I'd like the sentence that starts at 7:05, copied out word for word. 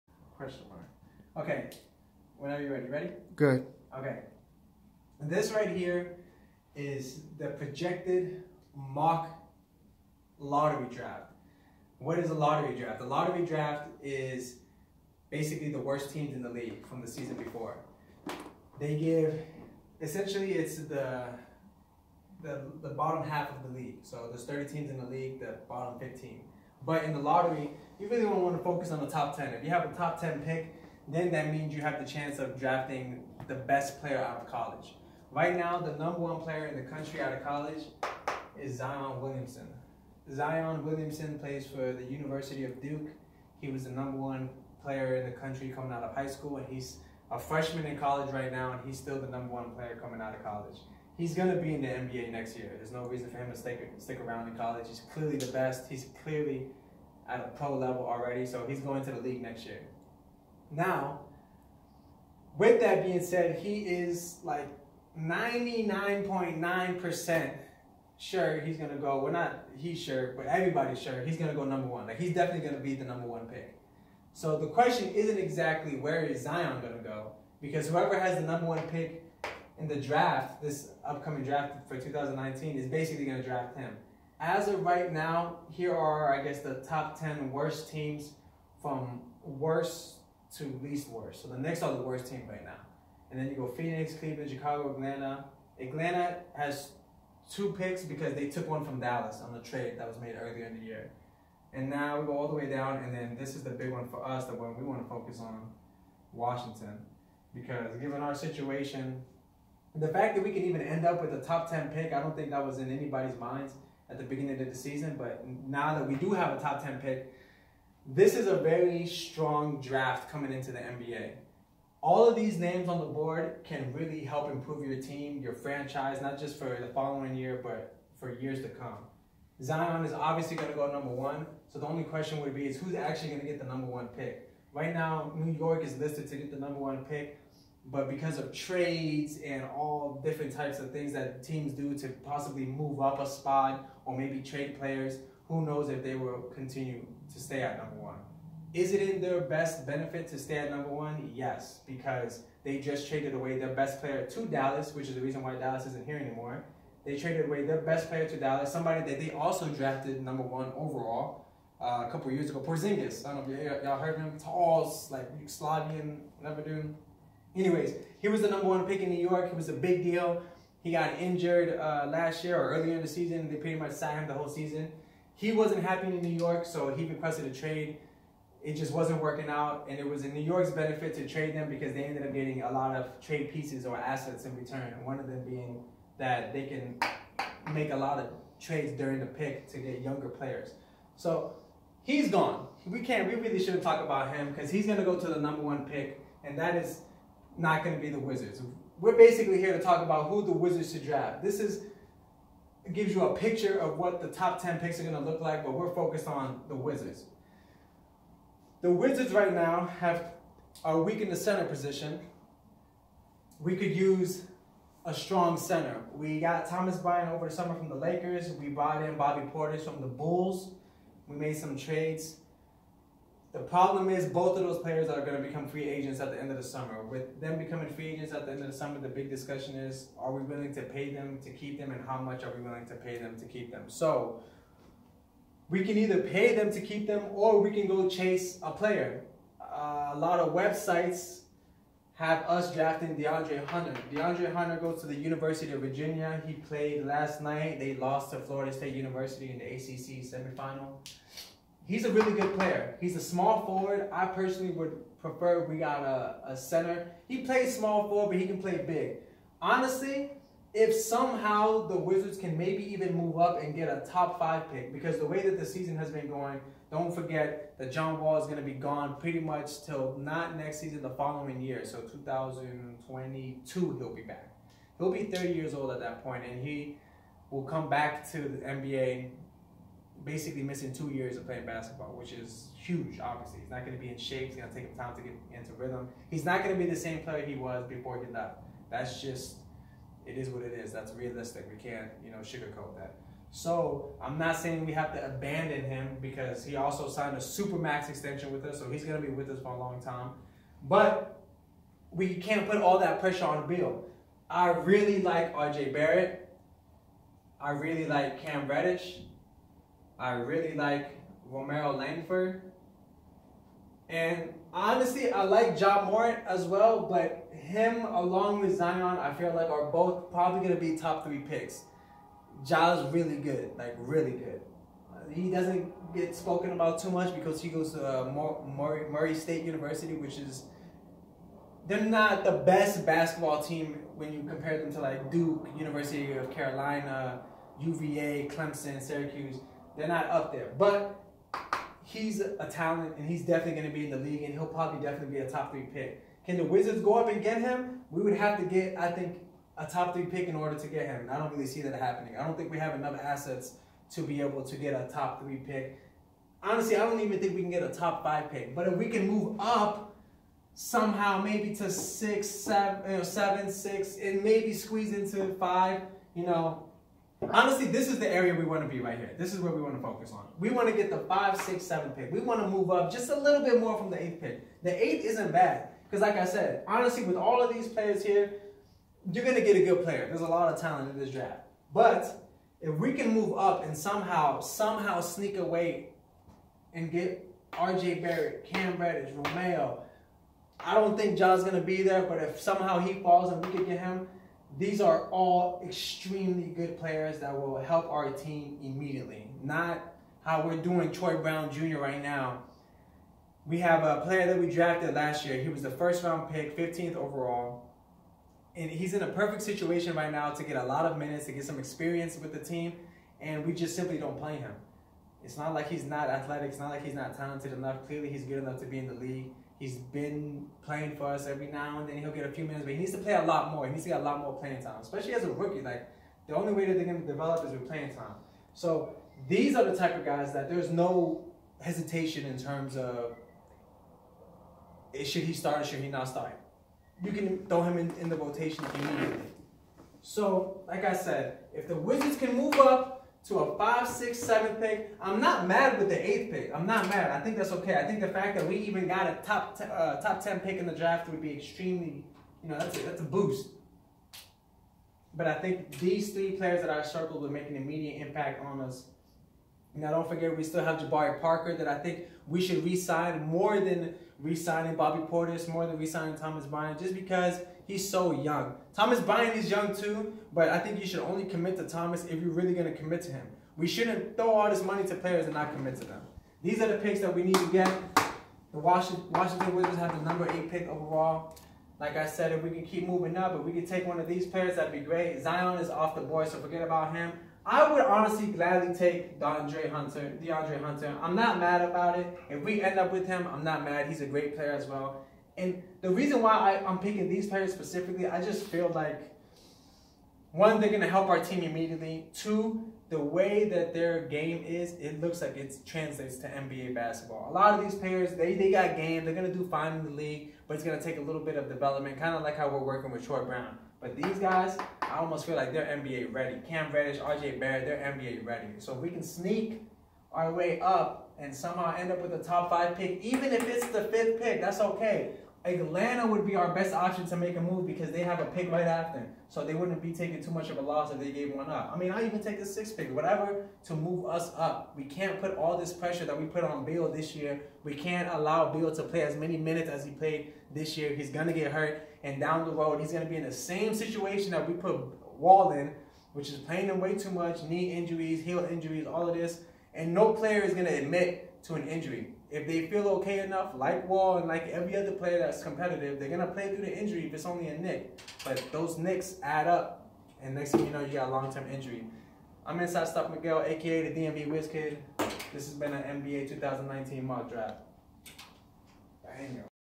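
Like the only way that they're going to develop is with playing time.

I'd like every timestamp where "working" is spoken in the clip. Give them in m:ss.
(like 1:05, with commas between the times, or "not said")
2:59, 8:32.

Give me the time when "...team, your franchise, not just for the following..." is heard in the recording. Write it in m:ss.
2:05.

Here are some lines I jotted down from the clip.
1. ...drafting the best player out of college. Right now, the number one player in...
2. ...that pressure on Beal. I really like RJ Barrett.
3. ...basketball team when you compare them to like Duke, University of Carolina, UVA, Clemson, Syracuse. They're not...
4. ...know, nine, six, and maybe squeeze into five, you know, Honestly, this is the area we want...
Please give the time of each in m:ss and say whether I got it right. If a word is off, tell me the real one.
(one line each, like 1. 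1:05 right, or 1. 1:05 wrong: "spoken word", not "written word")
1. 0:32 right
2. 5:02 right
3. 5:33 right
4. 6:03 wrong: "seven", not "nine".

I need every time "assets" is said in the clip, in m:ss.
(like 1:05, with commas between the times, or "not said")
3:03, 5:53.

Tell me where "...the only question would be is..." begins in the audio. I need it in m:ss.
2:11.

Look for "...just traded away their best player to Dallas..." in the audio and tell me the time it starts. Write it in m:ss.
2:32.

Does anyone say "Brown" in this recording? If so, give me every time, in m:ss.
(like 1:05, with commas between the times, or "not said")
6:41, 8:33.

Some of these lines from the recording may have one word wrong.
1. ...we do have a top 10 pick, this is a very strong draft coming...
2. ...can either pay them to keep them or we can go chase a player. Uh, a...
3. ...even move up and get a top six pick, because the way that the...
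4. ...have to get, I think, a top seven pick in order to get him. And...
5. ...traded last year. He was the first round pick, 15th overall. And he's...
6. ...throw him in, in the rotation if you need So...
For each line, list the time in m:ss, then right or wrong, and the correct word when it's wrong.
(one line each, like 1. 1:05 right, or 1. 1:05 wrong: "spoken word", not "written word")
1. 1:56 right
2. 3:55 right
3. 4:22 wrong: "five", not "six"
4. 5:48 wrong: "three", not "seven"
5. 6:44 wrong: "drafted", not "traded"
6. 7:17 right.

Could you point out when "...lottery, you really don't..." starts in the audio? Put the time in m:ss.
0:27.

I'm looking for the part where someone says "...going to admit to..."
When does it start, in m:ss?
9:10.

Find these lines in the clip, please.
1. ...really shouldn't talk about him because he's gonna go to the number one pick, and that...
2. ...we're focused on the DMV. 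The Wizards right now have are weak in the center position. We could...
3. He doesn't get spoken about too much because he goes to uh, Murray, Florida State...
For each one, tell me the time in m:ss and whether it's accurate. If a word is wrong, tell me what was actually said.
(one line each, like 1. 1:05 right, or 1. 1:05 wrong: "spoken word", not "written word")
1. 3:13 right
2. 3:25 wrong: "Wizards", not "DMV"
3. 5:25 wrong: "Murray", not "Florida".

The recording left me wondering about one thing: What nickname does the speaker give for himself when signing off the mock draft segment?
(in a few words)
DMV Whiz Kid.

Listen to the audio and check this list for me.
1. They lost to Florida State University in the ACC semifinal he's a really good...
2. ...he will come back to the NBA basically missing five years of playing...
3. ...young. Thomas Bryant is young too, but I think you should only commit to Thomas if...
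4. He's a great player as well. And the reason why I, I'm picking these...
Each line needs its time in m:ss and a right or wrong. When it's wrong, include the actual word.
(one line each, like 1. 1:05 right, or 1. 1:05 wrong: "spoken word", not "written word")
1. 4:07 right
2. 4:36 wrong: "two", not "five"
3. 7:48 right
4. 8:14 right.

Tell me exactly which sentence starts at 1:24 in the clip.
As of right now, here are, I guess, the top 10 worst teams from worst to least worst.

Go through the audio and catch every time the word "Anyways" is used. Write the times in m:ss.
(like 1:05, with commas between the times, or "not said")
2:47.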